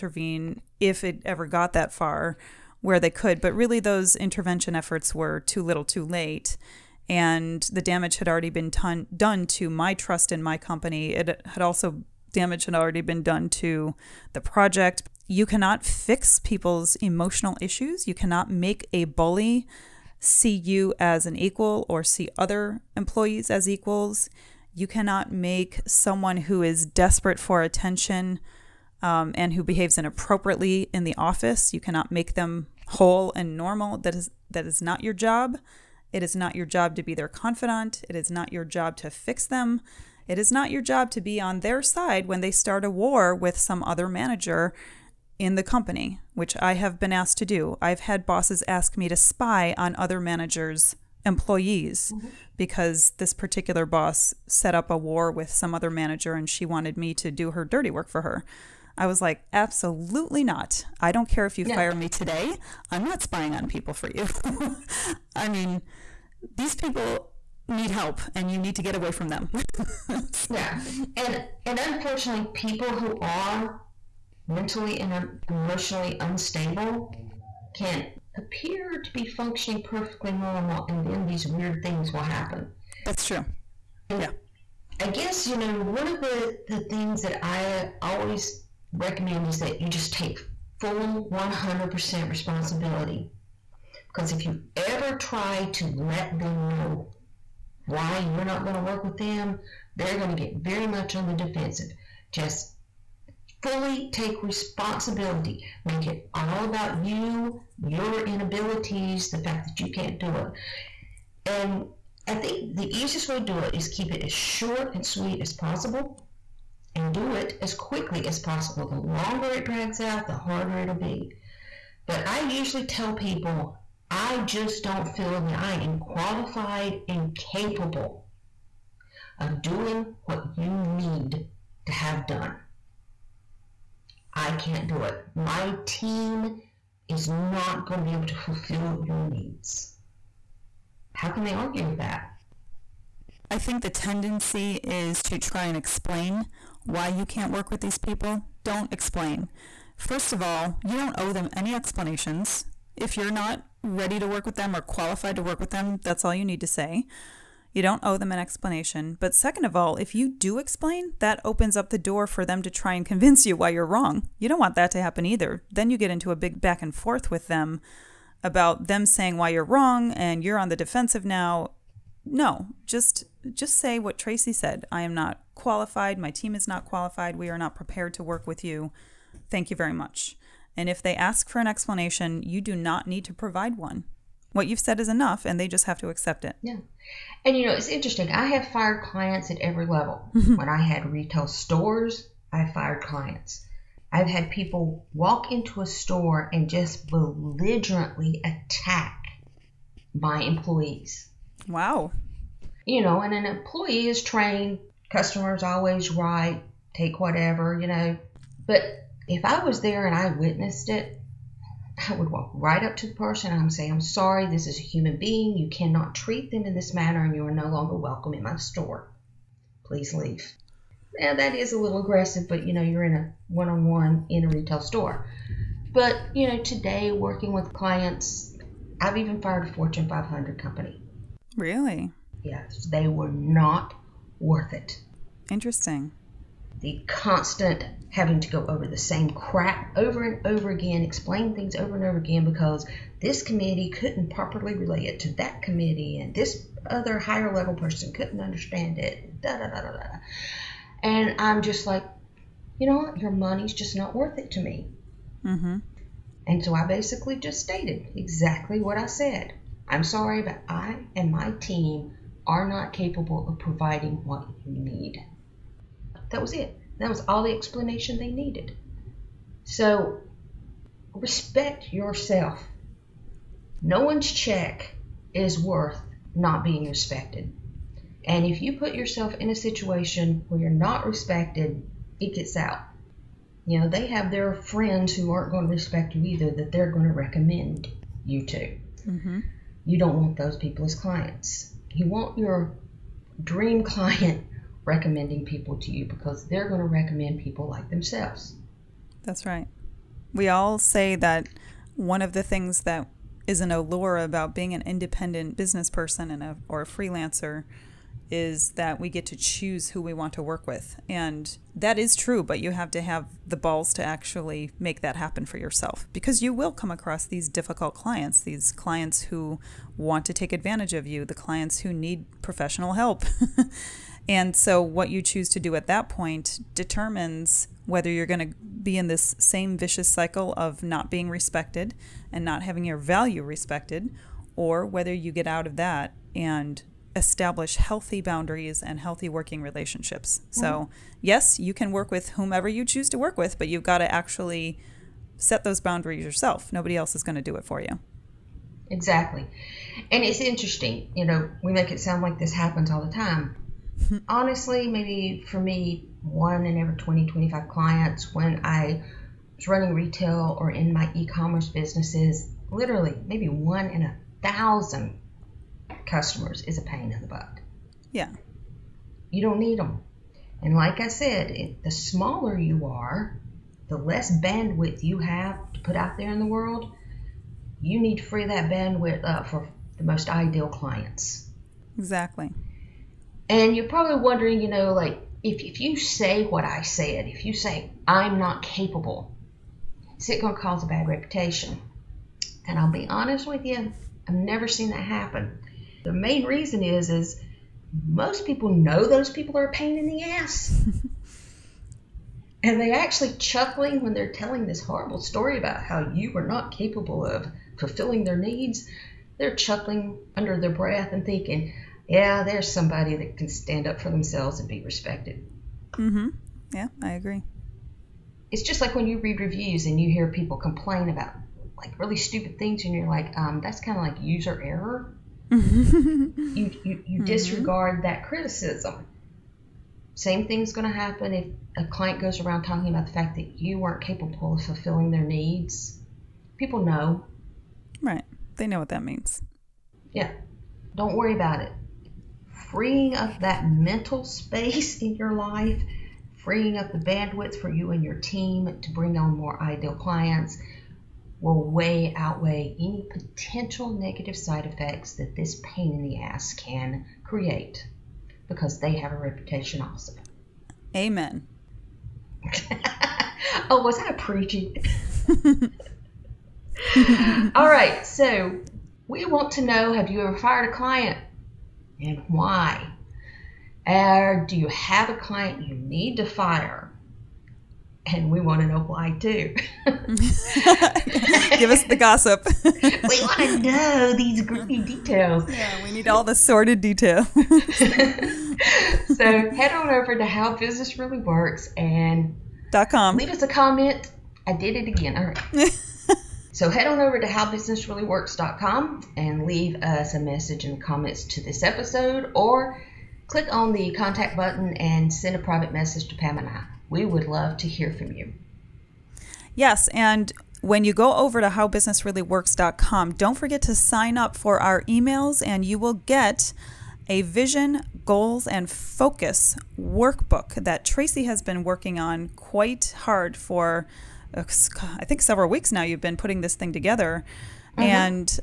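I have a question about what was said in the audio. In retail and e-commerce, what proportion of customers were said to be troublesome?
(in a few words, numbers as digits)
1 in 1000.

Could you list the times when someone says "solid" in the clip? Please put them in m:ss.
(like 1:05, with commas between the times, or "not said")
not said.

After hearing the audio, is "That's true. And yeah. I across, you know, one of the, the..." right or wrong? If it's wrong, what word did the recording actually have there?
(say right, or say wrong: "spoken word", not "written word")
wrong: "guess", not "across".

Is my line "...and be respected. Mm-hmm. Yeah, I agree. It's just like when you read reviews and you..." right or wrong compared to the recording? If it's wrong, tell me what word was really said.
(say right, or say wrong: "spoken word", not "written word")
right.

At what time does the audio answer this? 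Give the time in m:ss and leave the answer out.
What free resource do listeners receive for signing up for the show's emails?
8:37.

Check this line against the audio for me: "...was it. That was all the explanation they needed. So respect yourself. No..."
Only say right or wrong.
right.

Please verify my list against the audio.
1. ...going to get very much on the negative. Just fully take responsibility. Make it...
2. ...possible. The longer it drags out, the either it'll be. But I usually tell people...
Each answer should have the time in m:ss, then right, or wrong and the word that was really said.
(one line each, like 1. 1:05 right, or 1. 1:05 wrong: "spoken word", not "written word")
1. 1:40 wrong: "defensive", not "negative"
2. 1:58 wrong: "harder", not "either".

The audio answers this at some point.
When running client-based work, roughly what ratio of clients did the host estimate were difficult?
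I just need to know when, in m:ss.
5:56.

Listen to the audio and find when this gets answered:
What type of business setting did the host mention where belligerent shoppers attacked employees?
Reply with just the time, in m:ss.
3:11.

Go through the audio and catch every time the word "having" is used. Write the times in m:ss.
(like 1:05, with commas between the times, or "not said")
3:58, 5:32.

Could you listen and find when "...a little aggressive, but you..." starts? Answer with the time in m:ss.
3:41.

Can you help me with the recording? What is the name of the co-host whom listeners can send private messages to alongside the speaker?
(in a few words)
Pam.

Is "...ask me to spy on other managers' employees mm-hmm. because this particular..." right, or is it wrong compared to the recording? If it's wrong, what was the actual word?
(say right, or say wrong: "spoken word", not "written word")
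right.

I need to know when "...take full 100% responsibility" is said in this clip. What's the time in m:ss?
1:30.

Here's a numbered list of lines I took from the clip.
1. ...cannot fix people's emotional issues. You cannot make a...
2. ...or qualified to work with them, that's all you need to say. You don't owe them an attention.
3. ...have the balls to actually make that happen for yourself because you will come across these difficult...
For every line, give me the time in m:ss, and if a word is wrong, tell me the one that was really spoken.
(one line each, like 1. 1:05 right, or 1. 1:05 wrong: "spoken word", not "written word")
1. 0:15 right
2. 2:34 wrong: "explanation", not "attention"
3. 5:13 right.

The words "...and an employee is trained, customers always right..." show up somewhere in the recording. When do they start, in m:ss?
3:23.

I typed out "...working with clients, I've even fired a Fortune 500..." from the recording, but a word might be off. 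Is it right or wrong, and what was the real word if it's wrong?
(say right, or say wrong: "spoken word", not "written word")
right.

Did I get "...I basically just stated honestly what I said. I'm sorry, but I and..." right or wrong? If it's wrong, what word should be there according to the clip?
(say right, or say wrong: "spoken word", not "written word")
wrong: "exactly", not "honestly".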